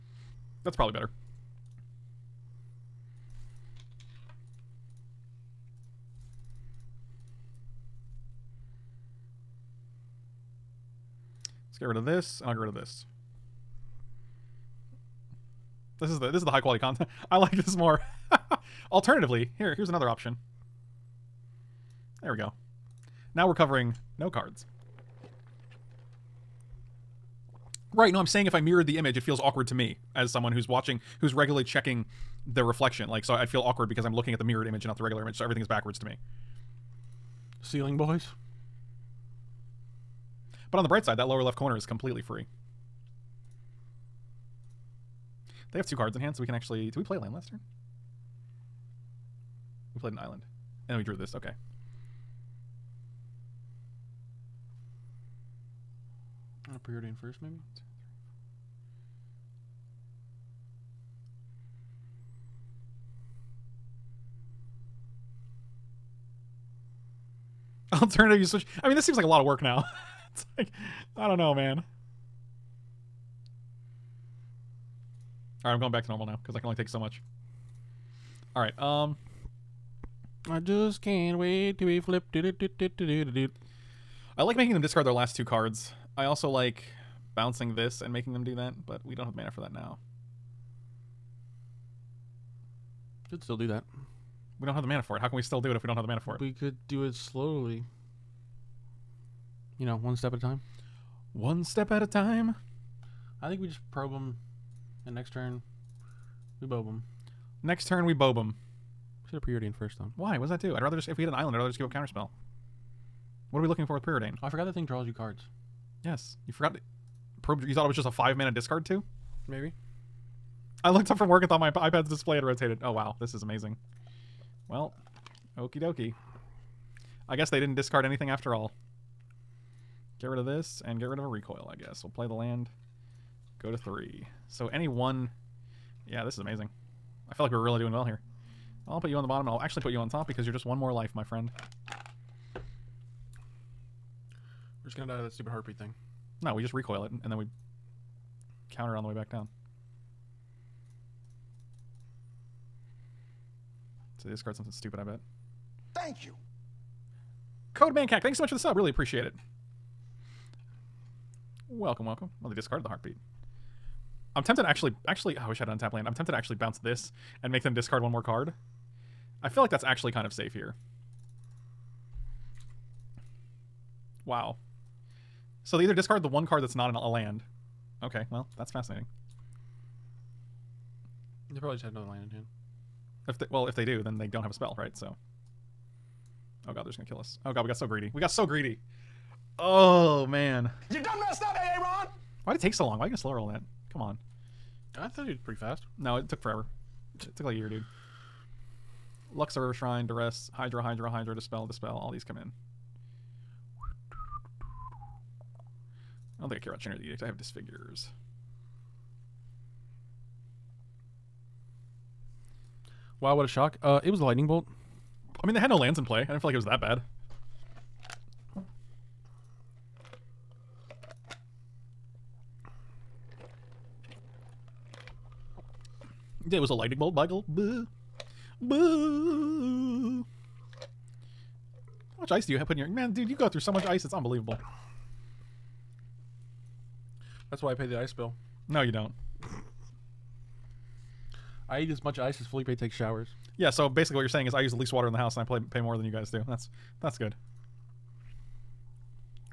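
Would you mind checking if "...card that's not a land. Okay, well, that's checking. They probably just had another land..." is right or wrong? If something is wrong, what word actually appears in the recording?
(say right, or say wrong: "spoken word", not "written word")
wrong: "fascinating", not "checking".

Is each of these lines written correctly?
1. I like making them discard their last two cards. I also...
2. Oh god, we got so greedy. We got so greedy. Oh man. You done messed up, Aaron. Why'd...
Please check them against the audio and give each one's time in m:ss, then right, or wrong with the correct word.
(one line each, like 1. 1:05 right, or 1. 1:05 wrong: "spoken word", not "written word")
1. 1:22 right
2. 3:07 right.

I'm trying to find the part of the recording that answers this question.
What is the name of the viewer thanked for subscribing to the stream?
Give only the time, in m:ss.
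2:37.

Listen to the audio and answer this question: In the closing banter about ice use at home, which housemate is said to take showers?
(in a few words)
Felipe.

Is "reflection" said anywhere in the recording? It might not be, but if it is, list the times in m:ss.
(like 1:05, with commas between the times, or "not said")
0:32.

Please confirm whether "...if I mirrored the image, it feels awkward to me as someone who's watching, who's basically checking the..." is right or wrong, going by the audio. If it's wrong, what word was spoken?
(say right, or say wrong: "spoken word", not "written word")
wrong: "regularly", not "basically".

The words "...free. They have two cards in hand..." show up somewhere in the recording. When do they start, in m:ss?
0:42.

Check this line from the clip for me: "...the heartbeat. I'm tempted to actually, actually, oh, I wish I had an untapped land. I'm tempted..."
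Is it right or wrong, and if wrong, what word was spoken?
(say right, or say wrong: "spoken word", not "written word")
right.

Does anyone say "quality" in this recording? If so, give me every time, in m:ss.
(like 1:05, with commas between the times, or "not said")
0:16.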